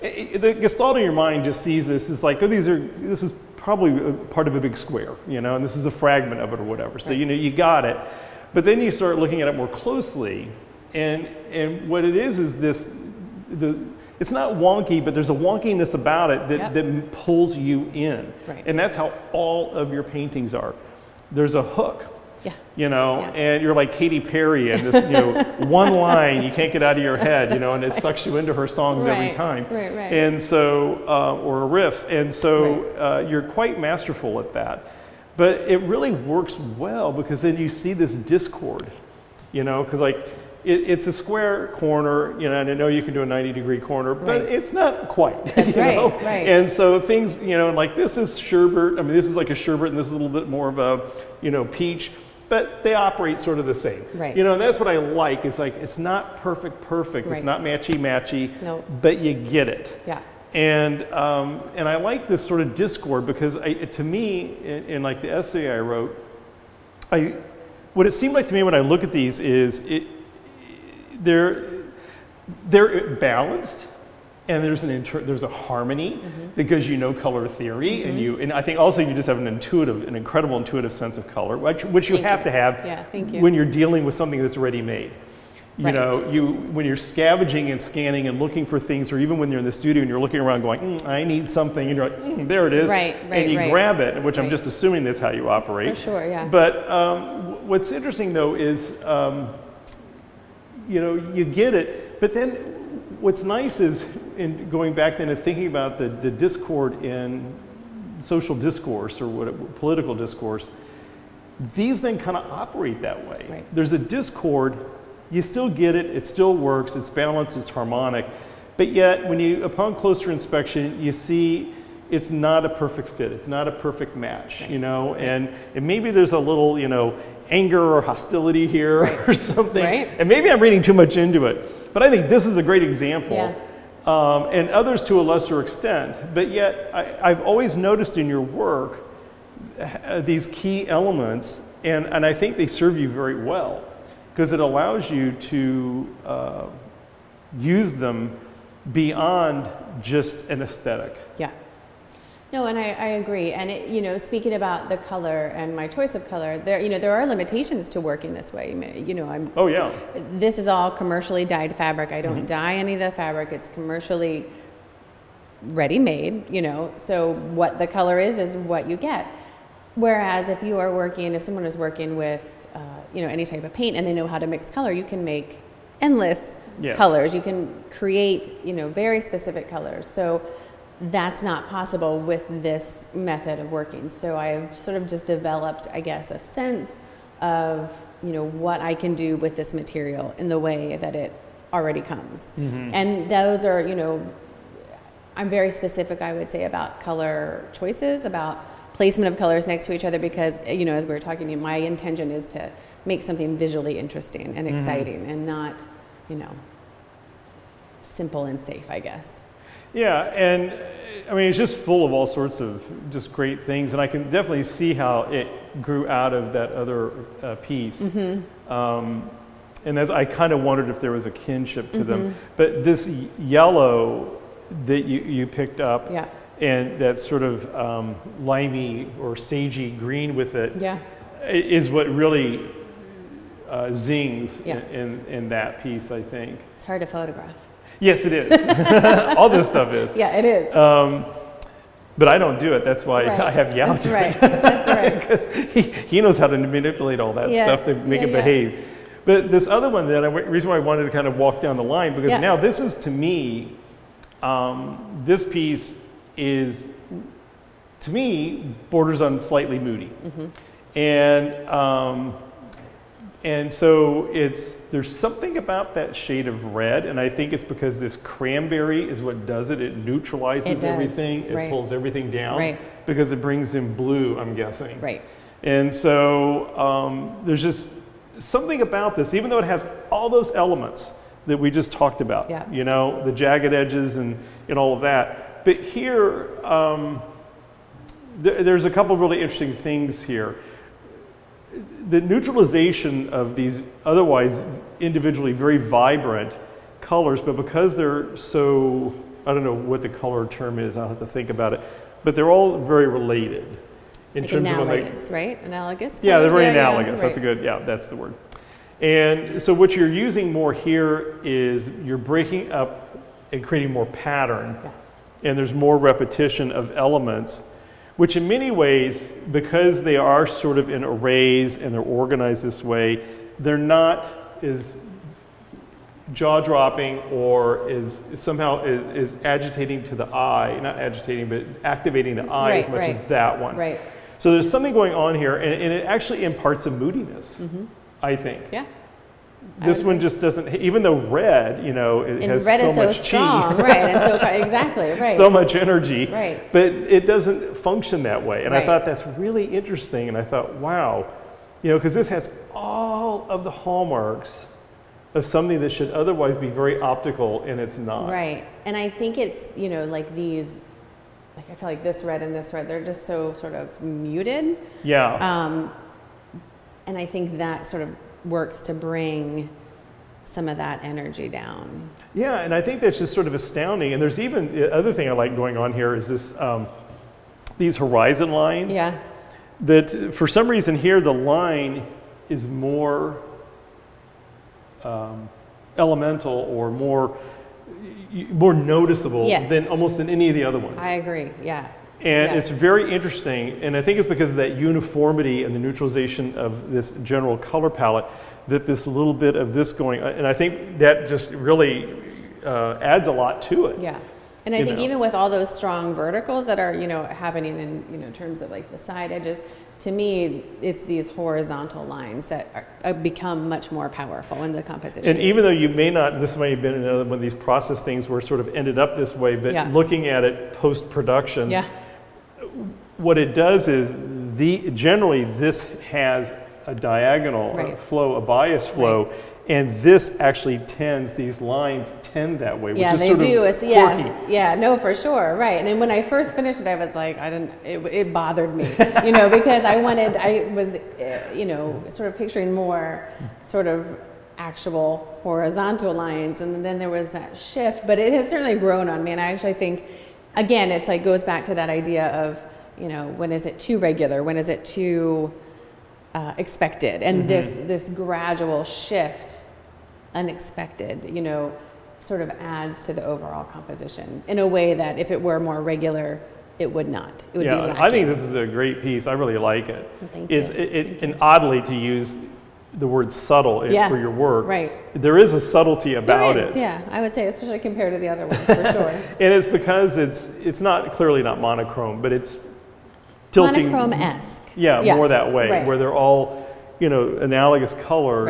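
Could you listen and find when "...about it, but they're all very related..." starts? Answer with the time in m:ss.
5:01.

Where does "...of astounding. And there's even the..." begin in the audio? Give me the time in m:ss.
6:13.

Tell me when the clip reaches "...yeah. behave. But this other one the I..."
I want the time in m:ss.
4:08.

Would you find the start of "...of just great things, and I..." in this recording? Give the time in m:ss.
3:32.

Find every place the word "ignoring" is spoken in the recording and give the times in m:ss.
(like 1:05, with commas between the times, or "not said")
not said.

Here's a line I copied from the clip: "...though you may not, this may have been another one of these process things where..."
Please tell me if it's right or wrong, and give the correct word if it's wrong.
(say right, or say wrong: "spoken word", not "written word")
right.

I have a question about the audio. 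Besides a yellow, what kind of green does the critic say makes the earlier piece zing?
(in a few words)
Limey or sagey green.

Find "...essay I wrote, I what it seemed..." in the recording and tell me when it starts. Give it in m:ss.
1:05.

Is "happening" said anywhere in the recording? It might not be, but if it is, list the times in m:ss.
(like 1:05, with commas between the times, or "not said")
6:47.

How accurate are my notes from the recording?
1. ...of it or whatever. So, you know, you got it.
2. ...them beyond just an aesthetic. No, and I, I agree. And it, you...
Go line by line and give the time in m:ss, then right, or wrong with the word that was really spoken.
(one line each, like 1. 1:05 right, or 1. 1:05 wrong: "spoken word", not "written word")
1. 0:06 right
2. 2:27 right.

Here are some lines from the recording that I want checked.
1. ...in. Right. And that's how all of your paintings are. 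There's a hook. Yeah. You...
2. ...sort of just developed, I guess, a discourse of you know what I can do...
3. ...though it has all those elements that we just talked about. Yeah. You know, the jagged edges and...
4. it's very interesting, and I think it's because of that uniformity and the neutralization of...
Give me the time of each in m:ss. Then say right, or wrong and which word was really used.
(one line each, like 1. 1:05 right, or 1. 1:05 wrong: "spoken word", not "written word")
1. 0:17 right
2. 3:04 wrong: "sense", not "discourse"
3. 4:39 right
4. 6:32 right.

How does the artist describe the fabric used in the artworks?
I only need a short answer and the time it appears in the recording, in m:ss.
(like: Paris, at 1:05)
Commercially dyed fabric, at 2:40.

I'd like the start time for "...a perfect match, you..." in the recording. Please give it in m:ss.
2:03.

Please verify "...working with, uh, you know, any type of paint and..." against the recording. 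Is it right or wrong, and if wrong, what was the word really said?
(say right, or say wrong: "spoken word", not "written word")
right.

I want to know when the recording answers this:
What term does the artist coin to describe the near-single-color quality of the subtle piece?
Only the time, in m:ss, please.
8:03.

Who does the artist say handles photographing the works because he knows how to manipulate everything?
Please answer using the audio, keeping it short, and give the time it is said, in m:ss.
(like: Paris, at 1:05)
Yao, at 4:03.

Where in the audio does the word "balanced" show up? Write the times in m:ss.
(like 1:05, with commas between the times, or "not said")
1:13, 1:57.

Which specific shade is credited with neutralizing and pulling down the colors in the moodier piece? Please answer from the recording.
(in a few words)
Cranberry.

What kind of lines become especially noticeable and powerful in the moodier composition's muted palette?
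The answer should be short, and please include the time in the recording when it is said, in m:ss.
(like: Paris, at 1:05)
Horizon lines, at 6:17.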